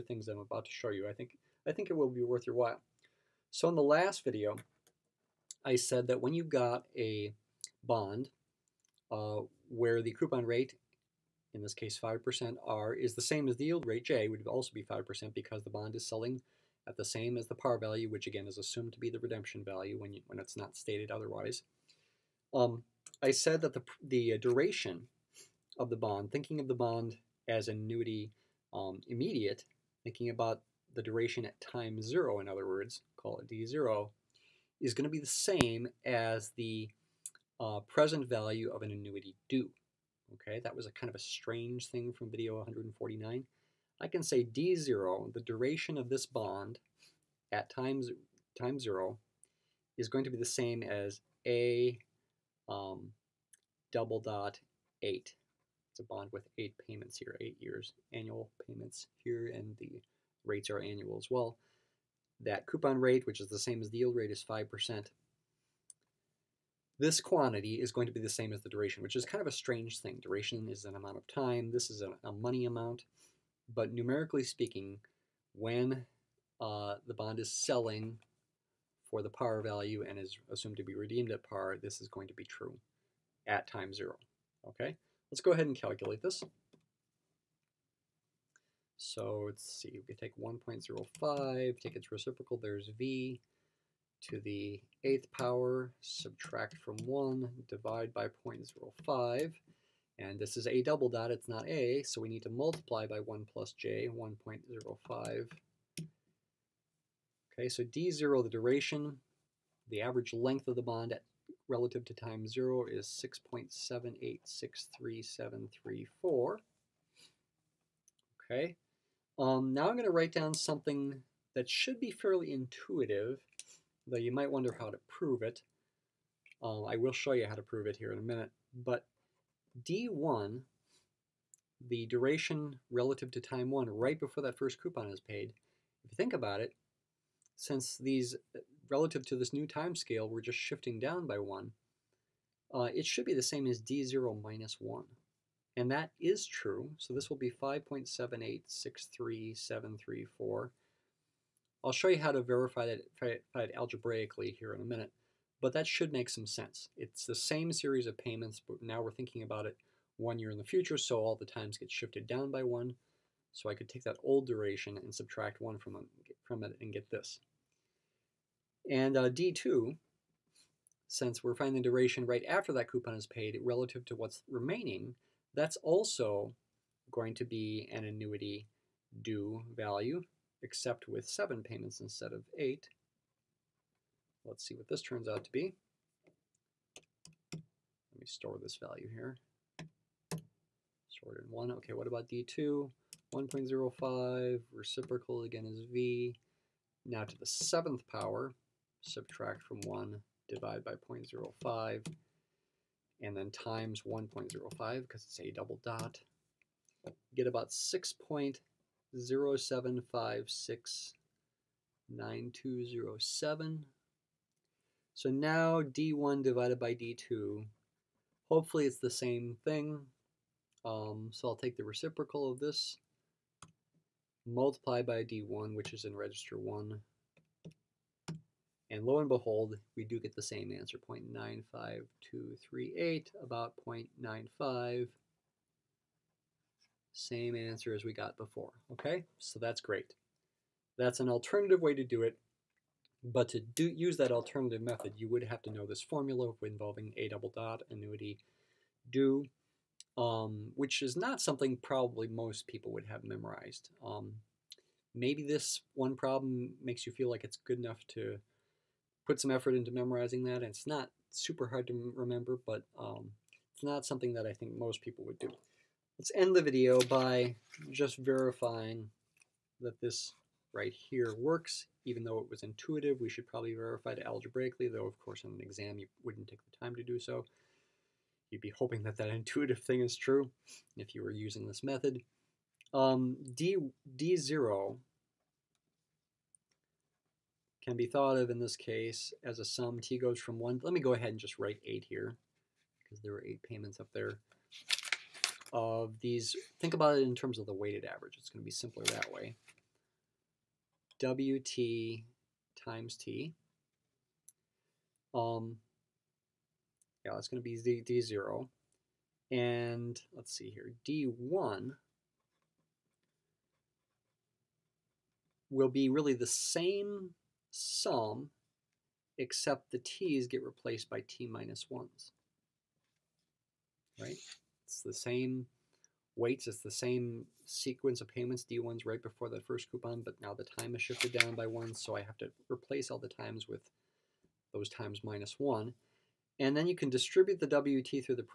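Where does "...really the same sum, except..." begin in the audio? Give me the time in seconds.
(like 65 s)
316 s.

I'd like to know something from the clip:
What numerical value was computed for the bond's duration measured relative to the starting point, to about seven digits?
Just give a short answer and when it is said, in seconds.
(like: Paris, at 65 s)
6.7863734, at 113 s.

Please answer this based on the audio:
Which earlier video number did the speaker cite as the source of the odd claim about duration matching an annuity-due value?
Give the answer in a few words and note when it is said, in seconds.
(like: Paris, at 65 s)
149, at 42 s.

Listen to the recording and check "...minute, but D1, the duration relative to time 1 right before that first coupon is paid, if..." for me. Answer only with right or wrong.
right.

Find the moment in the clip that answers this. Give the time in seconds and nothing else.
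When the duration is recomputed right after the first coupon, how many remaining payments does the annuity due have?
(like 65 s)
181 s.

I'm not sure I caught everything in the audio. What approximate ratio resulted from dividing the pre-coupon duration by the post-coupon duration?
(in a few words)
0.95238.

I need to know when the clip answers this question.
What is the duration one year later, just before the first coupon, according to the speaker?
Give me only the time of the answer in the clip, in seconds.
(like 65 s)
147 s.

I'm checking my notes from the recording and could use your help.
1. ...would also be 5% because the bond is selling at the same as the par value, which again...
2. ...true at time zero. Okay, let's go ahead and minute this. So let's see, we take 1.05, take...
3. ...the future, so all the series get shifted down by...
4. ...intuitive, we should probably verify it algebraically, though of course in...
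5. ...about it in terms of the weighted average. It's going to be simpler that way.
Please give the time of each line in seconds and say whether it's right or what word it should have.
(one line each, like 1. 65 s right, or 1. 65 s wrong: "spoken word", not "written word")
1. 14 s right
2. 82 s wrong: "calculate", not "minute"
3. 160 s wrong: "times", not "series"
4. 272 s right
5. 296 s right.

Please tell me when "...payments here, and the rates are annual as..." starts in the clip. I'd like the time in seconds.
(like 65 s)
58 s.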